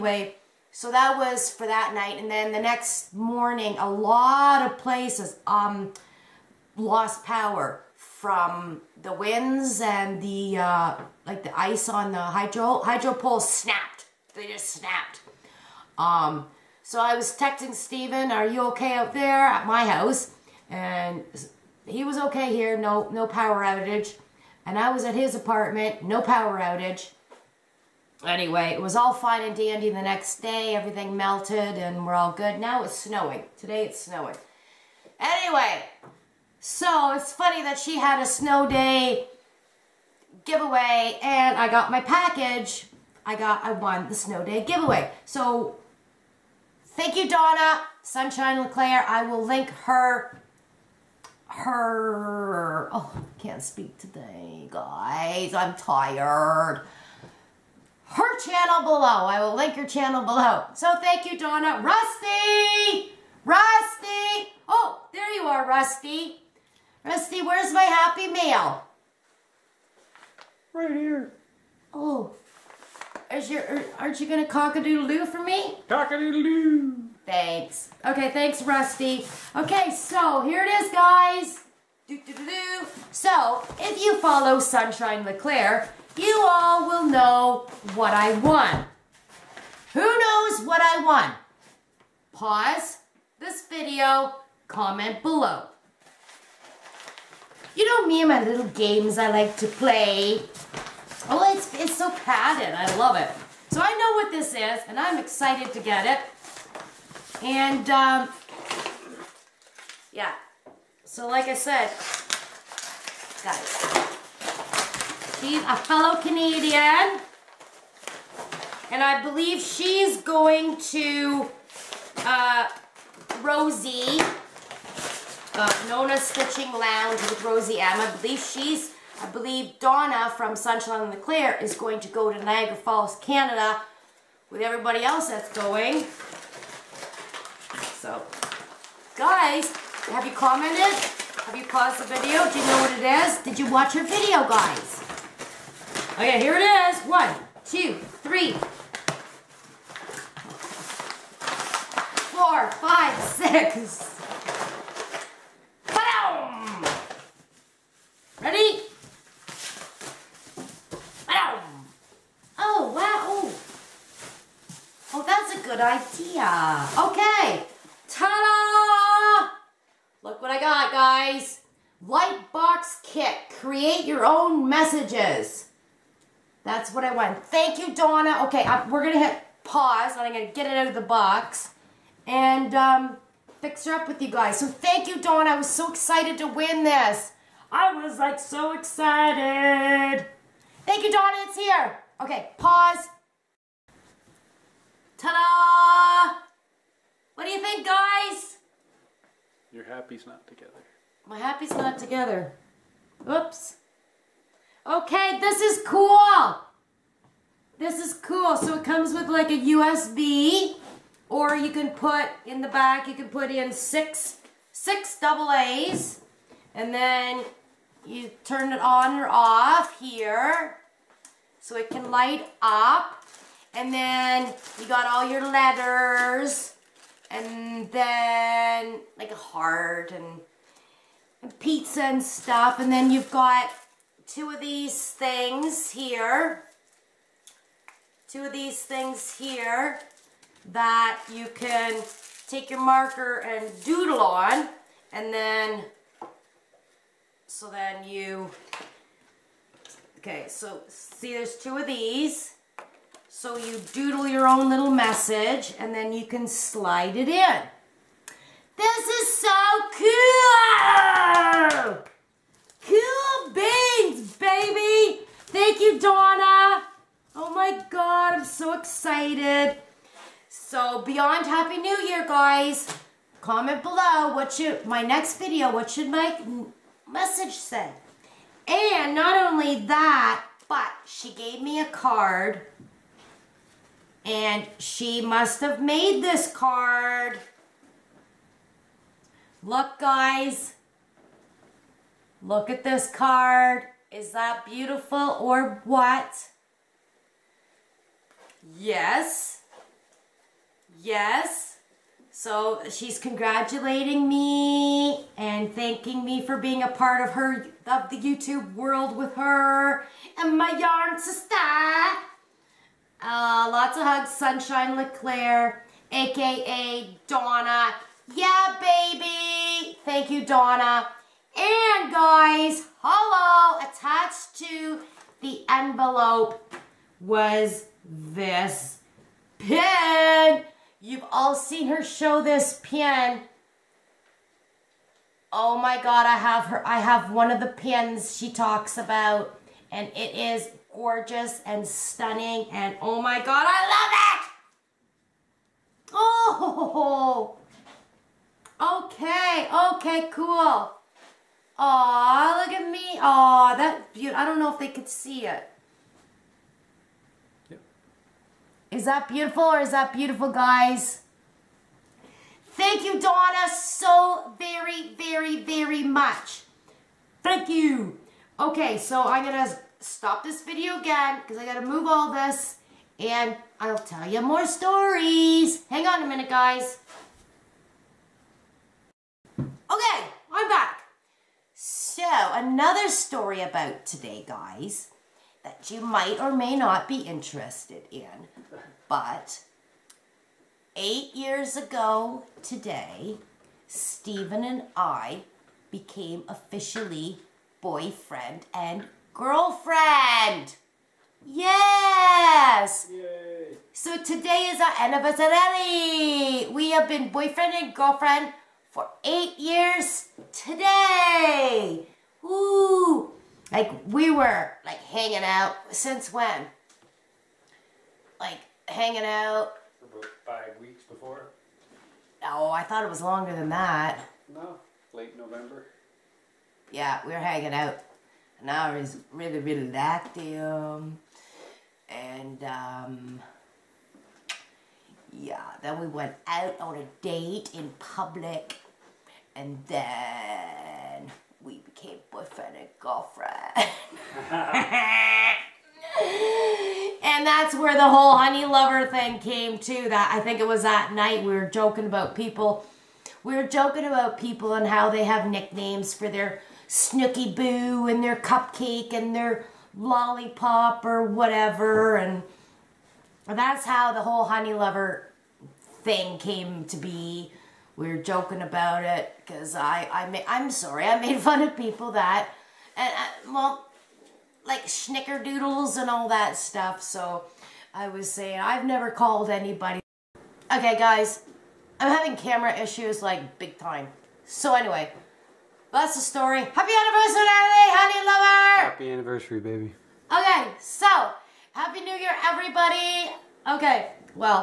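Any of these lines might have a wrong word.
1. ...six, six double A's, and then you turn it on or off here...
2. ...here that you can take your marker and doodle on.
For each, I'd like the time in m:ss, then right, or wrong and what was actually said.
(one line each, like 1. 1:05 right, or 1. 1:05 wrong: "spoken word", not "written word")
1. 3:33 right
2. 3:59 right.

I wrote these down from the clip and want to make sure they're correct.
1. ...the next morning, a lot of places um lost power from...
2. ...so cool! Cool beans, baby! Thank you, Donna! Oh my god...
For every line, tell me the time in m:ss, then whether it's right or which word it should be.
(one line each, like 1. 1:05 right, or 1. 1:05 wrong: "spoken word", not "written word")
1. 0:02 right
2. 4:19 right.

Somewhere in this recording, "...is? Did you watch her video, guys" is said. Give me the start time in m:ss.
2:23.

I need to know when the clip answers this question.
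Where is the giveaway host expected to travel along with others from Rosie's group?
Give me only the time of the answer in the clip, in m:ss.
2:12.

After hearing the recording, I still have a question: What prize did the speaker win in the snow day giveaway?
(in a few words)
Lightbox kit.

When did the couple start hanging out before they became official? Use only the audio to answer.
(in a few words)
Late November.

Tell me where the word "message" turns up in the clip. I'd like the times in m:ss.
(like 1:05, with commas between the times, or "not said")
2:54, 4:14, 4:37.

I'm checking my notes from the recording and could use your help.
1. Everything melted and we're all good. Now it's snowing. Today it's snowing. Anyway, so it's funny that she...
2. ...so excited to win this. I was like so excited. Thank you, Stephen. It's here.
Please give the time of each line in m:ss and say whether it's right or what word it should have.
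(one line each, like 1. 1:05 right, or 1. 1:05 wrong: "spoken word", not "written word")
1. 0:30 right
2. 3:05 wrong: "Donna", not "Stephen".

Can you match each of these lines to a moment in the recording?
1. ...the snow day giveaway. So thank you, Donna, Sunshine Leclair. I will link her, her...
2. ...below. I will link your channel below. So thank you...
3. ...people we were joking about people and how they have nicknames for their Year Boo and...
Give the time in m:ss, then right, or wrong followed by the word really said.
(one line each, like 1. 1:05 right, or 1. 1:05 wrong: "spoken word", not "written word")
1. 0:44 right
2. 0:58 right
3. 7:32 wrong: "Snooky", not "Year".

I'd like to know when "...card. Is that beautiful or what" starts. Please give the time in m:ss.
4:53.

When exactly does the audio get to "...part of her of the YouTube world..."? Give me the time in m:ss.
5:06.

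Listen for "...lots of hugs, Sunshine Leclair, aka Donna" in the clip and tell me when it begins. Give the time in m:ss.
5:13.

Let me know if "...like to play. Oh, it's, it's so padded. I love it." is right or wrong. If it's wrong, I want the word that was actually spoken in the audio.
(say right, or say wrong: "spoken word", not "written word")
right.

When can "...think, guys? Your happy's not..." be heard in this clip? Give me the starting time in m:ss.
3:17.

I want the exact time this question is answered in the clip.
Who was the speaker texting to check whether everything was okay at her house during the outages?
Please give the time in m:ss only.
0:17.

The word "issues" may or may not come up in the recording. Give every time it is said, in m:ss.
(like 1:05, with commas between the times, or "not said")
8:02.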